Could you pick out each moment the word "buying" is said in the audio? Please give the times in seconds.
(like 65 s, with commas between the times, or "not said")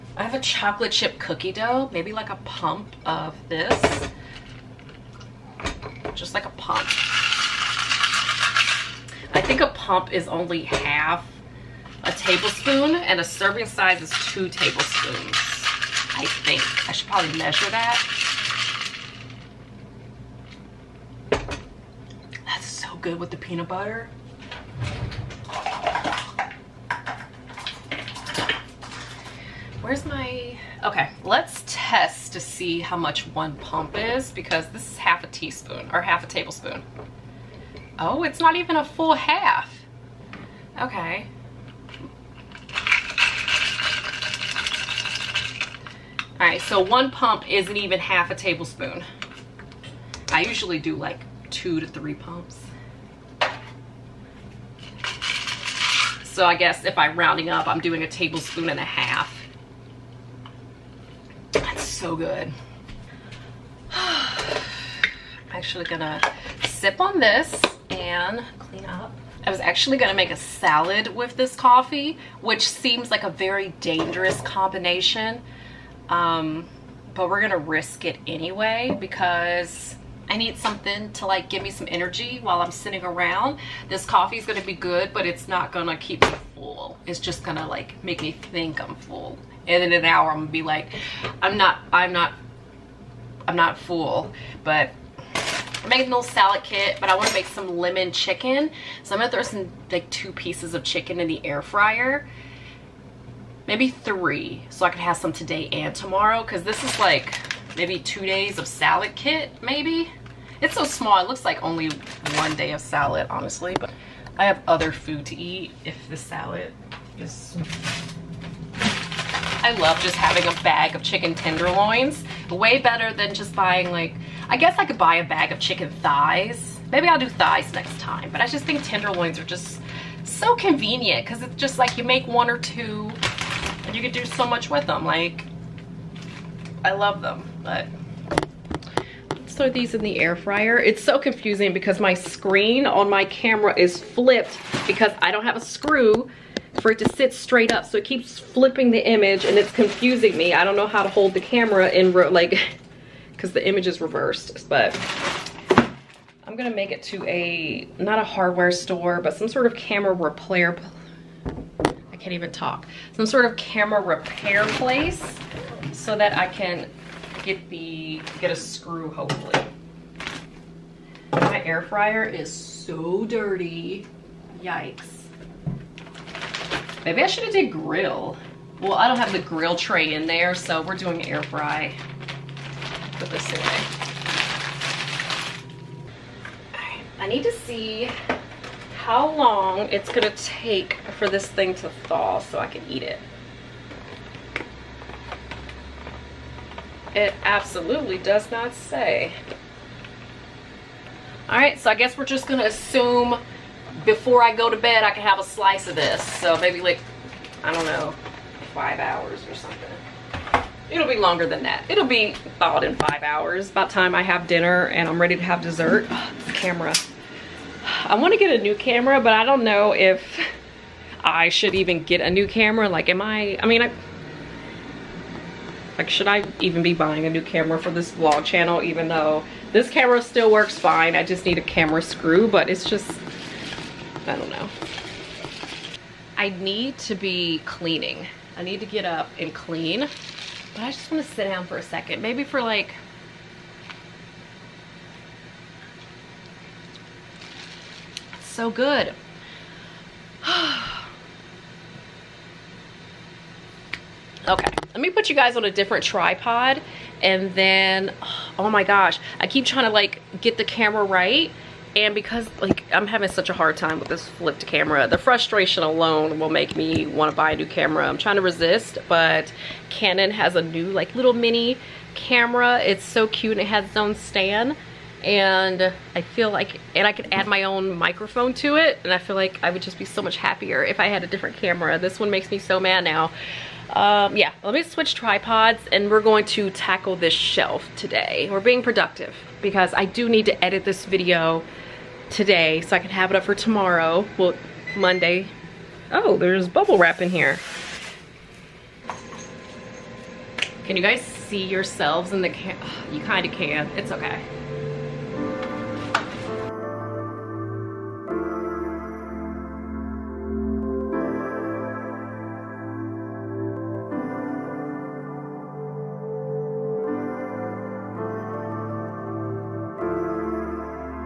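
123 s, 226 s.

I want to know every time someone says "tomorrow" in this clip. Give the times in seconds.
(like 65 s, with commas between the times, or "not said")
105 s, 293 s.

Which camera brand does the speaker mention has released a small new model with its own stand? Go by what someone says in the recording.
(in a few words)
Canon.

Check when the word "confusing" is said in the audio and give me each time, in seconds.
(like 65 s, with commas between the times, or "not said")
141 s, 149 s.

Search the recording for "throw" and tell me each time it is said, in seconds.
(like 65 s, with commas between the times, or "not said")
99 s, 139 s.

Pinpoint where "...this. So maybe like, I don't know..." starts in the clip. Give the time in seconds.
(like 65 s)
205 s.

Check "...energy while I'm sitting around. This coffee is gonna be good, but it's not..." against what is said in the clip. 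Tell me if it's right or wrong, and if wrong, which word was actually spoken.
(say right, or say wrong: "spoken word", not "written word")
right.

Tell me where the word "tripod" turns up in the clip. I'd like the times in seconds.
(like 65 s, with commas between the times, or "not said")
256 s, 285 s.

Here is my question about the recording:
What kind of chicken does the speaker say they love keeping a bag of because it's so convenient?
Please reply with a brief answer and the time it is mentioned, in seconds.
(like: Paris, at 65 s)
chicken tenderloins, at 121 s.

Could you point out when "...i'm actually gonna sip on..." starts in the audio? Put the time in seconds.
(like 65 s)
63 s.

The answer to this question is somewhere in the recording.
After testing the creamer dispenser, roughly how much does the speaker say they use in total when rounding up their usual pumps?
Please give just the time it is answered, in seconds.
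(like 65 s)
58 s.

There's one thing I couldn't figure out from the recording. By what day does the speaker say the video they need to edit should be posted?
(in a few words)
Monday.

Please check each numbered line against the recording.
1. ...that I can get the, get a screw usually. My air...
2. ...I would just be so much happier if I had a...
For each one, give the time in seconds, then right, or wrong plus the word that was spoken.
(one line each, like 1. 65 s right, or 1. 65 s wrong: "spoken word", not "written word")
1. 166 s wrong: "hopefully", not "usually"
2. 279 s right.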